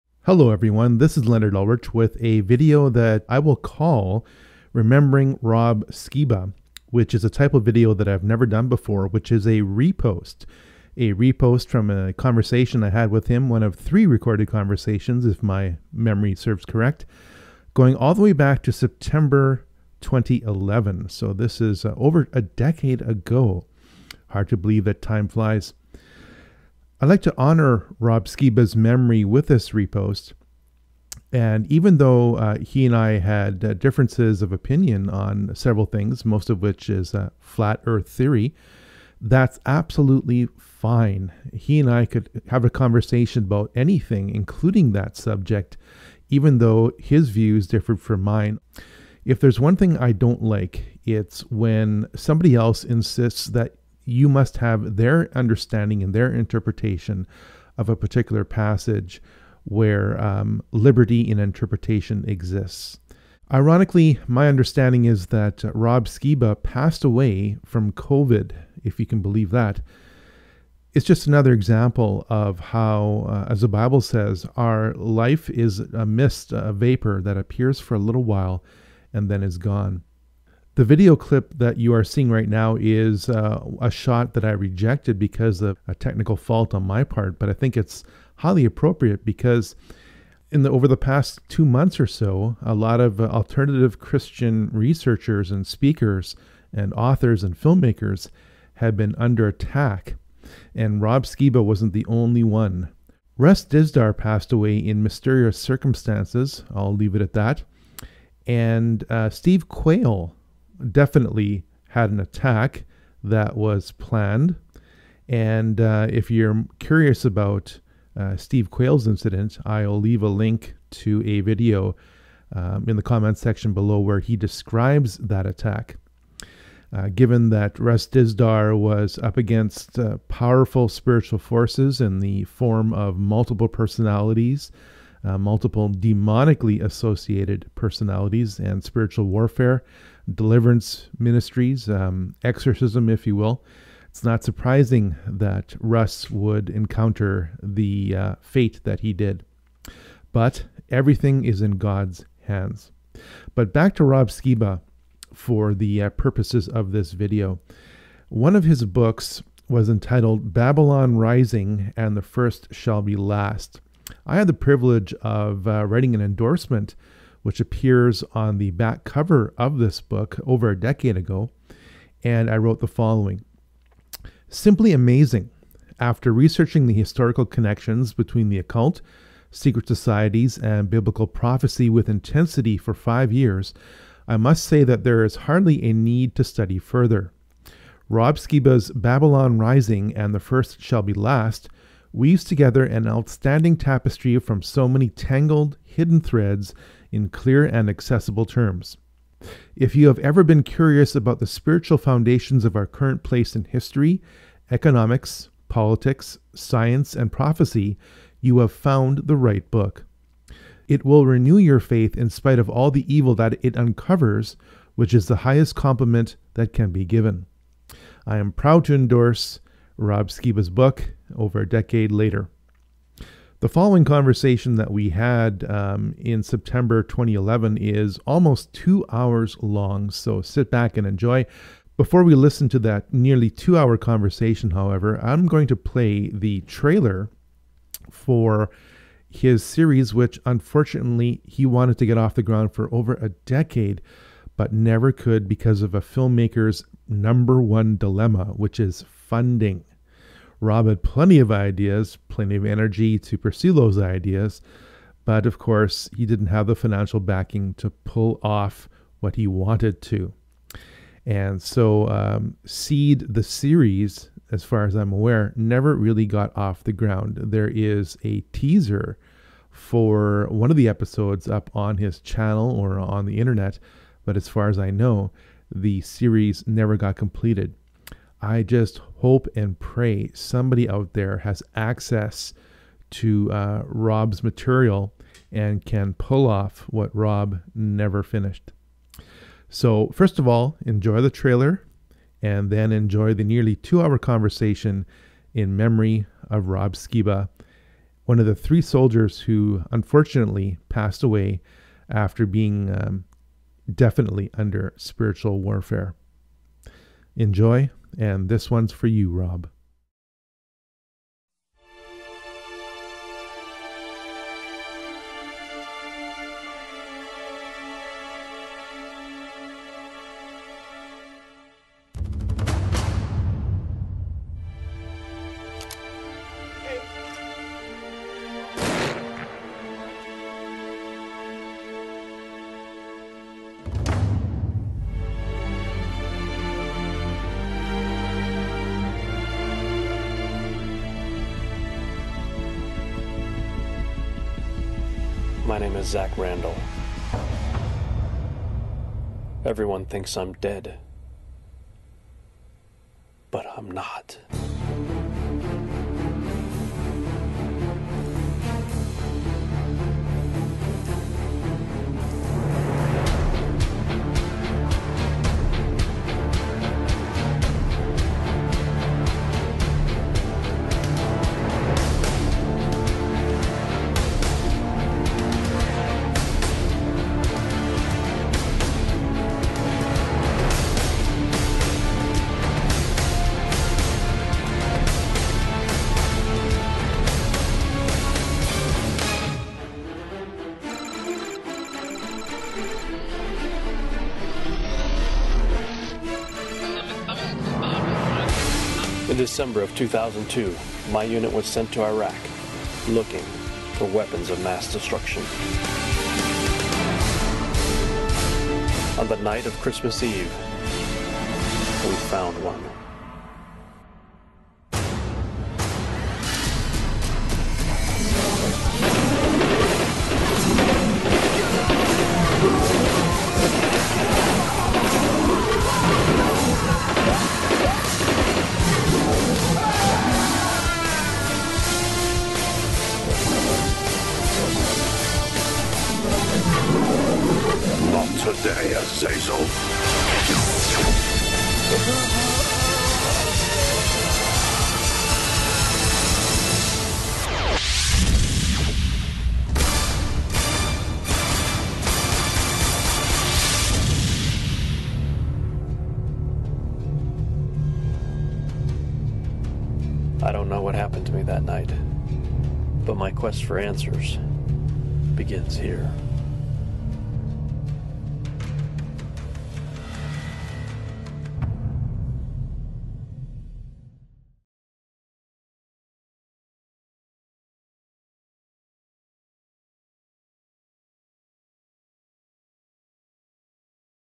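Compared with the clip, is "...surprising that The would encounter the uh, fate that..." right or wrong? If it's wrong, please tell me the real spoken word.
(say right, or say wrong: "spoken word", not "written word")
wrong: "Russ", not "The".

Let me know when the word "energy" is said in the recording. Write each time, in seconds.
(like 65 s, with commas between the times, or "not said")
252 s.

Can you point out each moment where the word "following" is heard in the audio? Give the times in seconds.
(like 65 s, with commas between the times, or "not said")
172 s, 223 s.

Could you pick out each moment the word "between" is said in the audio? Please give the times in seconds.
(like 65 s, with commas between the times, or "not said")
178 s.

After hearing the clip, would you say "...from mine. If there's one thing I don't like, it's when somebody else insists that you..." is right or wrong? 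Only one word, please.
right.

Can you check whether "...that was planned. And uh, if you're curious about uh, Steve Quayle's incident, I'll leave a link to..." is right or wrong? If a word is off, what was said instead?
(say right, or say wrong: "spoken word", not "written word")
right.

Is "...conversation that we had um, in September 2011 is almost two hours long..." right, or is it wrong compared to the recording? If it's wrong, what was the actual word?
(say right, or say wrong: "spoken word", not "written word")
right.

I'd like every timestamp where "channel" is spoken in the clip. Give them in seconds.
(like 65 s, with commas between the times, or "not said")
272 s.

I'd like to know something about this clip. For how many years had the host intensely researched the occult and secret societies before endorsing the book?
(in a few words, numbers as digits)
5.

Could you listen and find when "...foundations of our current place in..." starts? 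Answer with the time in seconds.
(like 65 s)
201 s.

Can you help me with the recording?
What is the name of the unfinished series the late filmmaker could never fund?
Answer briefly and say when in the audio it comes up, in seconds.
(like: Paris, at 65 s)
Seed, at 262 s.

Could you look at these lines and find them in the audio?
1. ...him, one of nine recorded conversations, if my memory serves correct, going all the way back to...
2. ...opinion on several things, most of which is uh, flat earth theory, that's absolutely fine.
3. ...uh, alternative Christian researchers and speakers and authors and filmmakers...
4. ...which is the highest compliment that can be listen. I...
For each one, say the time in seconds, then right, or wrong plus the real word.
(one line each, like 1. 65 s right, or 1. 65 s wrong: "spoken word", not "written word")
1. 13 s wrong: "three", not "nine"
2. 34 s right
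3. 93 s right
4. 214 s wrong: "given", not "listen".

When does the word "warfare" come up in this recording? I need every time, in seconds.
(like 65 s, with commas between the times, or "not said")
139 s, 305 s.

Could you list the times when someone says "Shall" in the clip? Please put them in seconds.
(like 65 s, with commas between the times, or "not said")
162 s, 190 s.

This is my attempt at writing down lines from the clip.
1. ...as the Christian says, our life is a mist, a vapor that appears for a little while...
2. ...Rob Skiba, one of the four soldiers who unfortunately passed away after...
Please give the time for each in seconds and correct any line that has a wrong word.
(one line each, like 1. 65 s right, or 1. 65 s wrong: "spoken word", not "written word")
1. 73 s wrong: "Bible", not "Christian"
2. 296 s wrong: "three", not "four".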